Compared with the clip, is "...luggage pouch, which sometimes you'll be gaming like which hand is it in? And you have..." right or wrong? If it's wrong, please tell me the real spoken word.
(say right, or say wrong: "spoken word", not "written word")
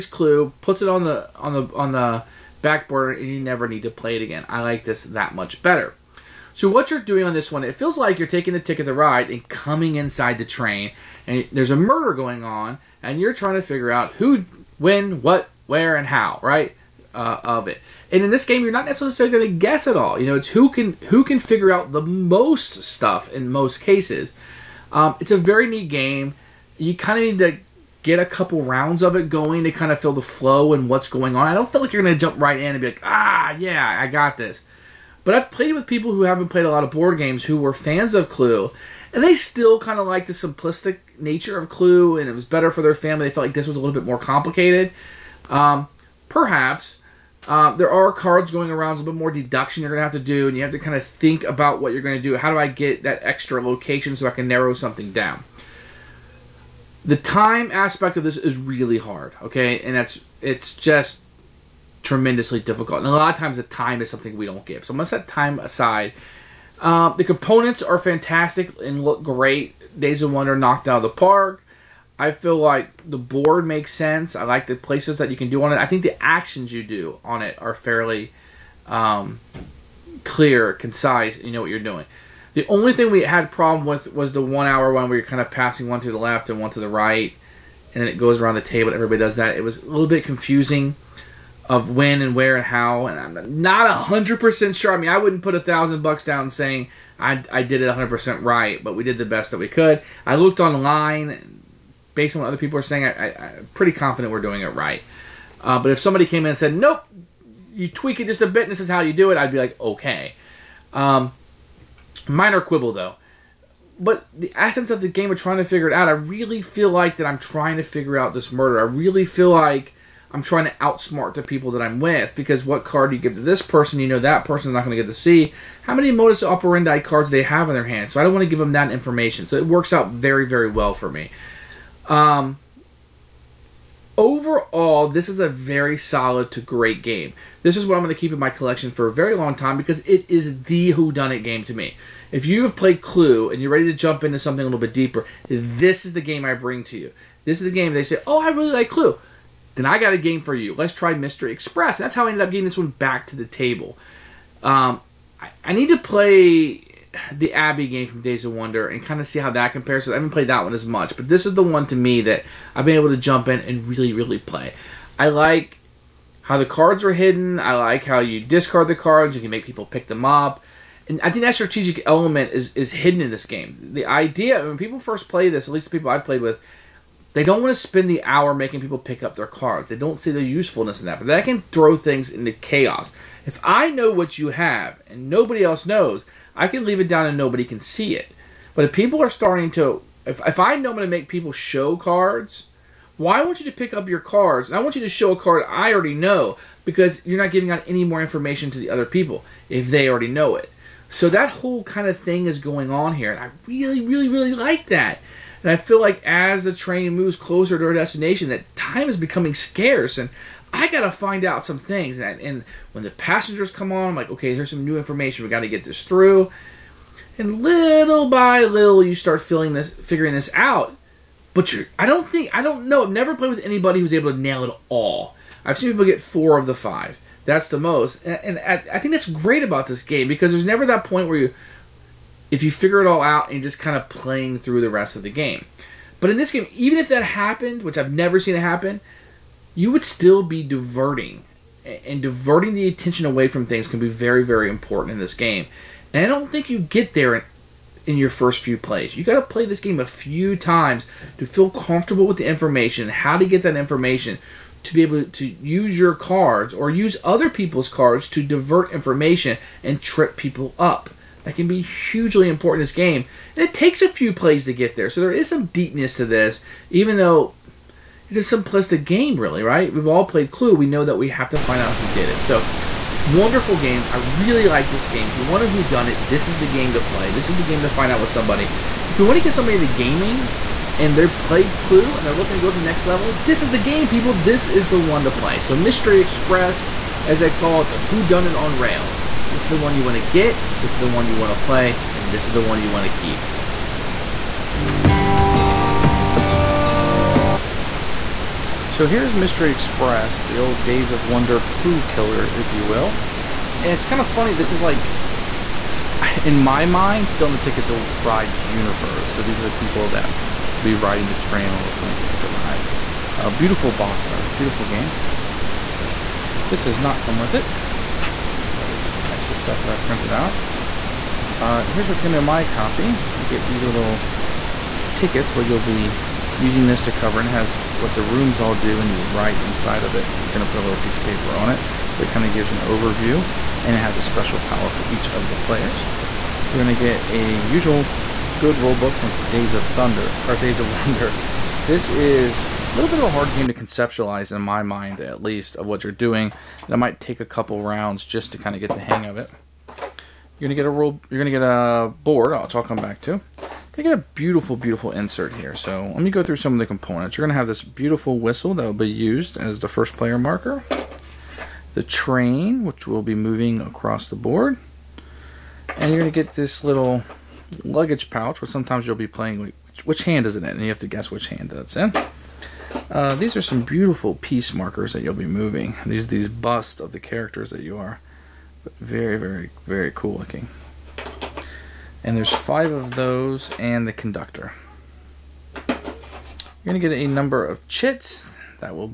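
wrong: "playing", not "gaming".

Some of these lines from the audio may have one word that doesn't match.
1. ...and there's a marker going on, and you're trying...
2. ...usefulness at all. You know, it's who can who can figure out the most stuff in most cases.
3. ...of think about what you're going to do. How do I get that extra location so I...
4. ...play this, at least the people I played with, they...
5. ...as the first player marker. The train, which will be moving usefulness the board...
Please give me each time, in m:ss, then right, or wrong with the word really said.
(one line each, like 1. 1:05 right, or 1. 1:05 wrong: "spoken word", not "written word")
1. 0:11 wrong: "murder", not "marker"
2. 0:19 wrong: "guess", not "usefulness"
3. 0:50 right
4. 2:55 right
5. 5:59 wrong: "across", not "usefulness".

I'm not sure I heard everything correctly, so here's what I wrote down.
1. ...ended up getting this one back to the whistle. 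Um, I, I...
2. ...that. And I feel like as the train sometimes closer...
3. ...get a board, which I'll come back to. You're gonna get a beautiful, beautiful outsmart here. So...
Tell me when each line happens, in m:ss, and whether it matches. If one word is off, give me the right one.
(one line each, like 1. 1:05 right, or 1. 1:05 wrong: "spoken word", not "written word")
1. 2:32 wrong: "table", not "whistle"
2. 3:24 wrong: "moves", not "sometimes"
3. 5:51 wrong: "insert", not "outsmart".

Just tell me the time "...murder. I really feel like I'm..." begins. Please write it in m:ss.
1:58.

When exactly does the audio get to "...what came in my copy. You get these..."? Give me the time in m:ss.
5:22.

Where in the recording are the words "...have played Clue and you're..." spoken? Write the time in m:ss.
2:22.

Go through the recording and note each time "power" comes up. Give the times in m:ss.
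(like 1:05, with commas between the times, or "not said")
5:34.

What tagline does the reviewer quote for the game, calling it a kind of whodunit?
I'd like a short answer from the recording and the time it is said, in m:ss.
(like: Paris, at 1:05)
who done it on rails, at 4:47.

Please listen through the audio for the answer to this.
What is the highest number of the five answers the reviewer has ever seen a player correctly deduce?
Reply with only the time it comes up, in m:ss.
3:46.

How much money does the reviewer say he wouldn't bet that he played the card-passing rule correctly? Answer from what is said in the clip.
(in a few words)
1000 dollars.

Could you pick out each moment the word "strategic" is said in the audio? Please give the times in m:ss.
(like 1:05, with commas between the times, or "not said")
2:51.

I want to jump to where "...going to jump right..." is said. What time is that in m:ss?
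0:32.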